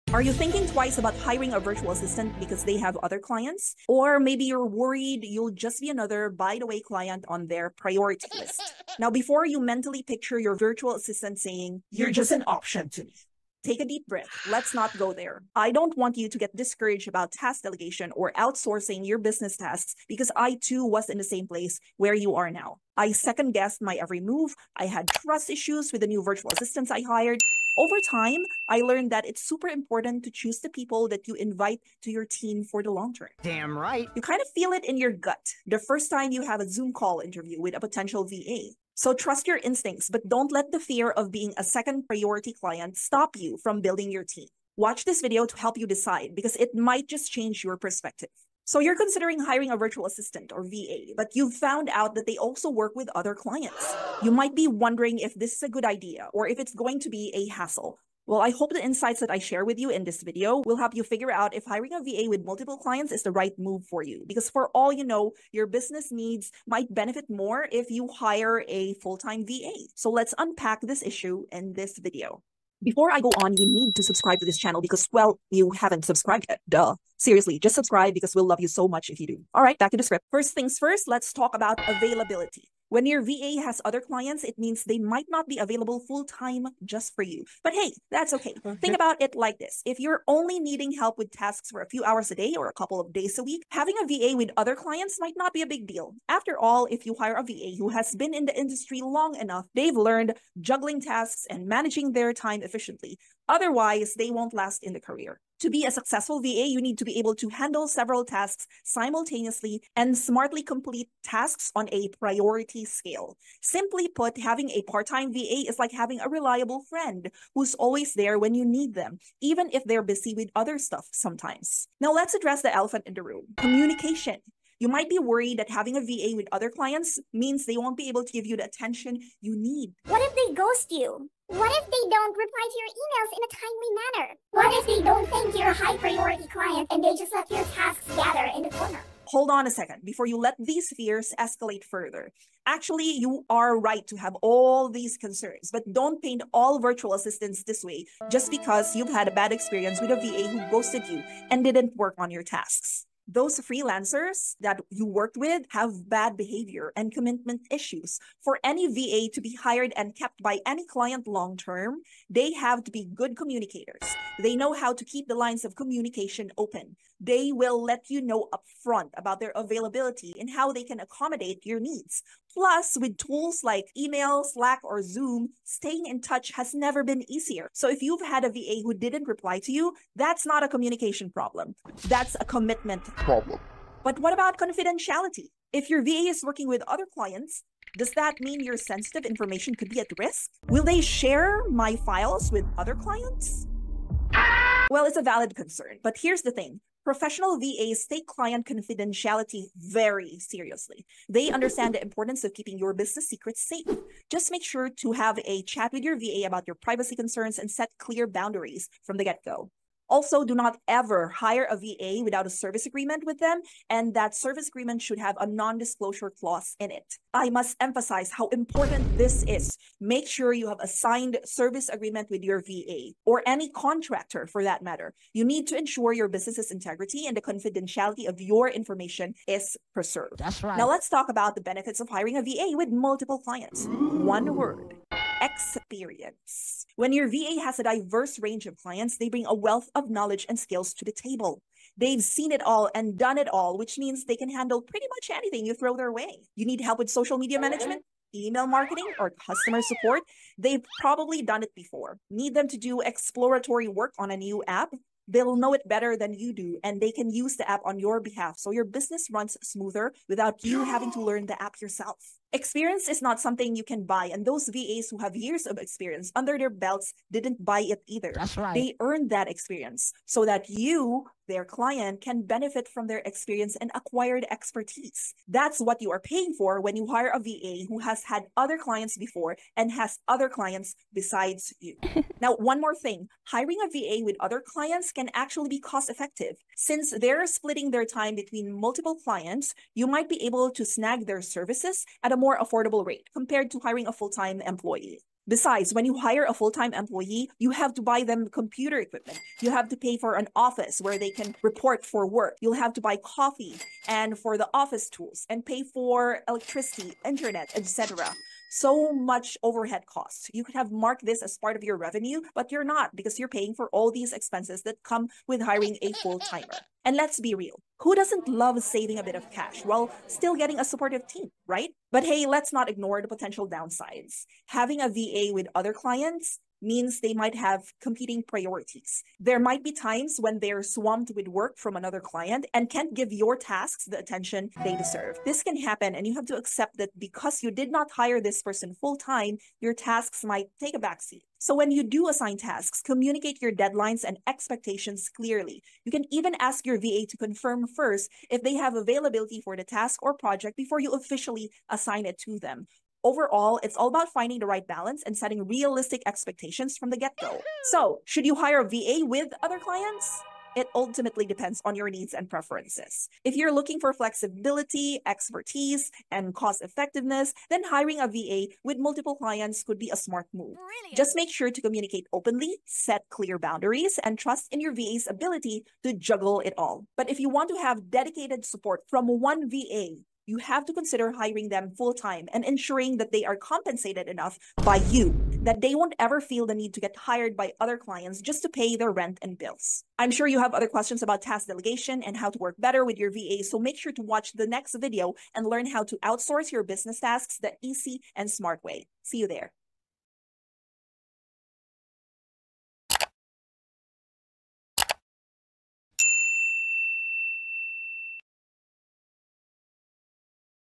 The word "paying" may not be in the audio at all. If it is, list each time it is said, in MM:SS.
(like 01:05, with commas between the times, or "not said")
04:36, 05:13.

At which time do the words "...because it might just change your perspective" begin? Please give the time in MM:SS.
00:46.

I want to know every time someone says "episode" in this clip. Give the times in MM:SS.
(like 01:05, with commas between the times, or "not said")
not said.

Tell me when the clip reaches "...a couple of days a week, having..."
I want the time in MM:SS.
01:32.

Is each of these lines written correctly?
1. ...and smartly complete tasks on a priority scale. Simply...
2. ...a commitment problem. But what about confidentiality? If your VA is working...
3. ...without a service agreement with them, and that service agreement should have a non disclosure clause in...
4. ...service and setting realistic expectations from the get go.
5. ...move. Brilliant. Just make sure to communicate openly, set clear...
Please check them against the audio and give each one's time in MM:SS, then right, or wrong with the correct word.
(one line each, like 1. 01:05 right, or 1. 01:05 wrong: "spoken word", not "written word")
1. 01:49 right
2. 03:02 right
3. 03:32 right
4. 05:54 wrong: "balance", not "service"
5. 06:10 right.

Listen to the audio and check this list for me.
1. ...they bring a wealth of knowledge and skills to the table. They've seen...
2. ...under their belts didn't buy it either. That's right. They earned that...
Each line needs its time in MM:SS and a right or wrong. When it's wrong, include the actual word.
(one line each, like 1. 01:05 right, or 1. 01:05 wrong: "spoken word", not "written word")
1. 03:59 right
2. 04:26 right.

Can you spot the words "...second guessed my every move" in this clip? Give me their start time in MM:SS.
00:23.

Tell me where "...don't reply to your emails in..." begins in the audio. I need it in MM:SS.
02:12.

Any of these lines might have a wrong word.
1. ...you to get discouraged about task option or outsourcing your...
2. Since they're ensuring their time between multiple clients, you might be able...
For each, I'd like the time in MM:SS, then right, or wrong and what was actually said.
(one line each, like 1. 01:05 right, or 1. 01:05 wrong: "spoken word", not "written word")
1. 00:16 wrong: "delegation", not "option"
2. 04:46 wrong: "splitting", not "ensuring".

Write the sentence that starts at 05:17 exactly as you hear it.
And let's be real, who doesn't love saving a bit of cash while still getting a supportive team, right?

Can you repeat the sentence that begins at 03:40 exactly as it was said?
Make sure you have a signed service agreement with your VA or any contractor for that matter.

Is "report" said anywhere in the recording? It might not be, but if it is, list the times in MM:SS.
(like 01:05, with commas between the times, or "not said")
05:01.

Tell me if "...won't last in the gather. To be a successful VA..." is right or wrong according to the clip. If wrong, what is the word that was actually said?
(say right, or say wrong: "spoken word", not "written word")
wrong: "career", not "gather".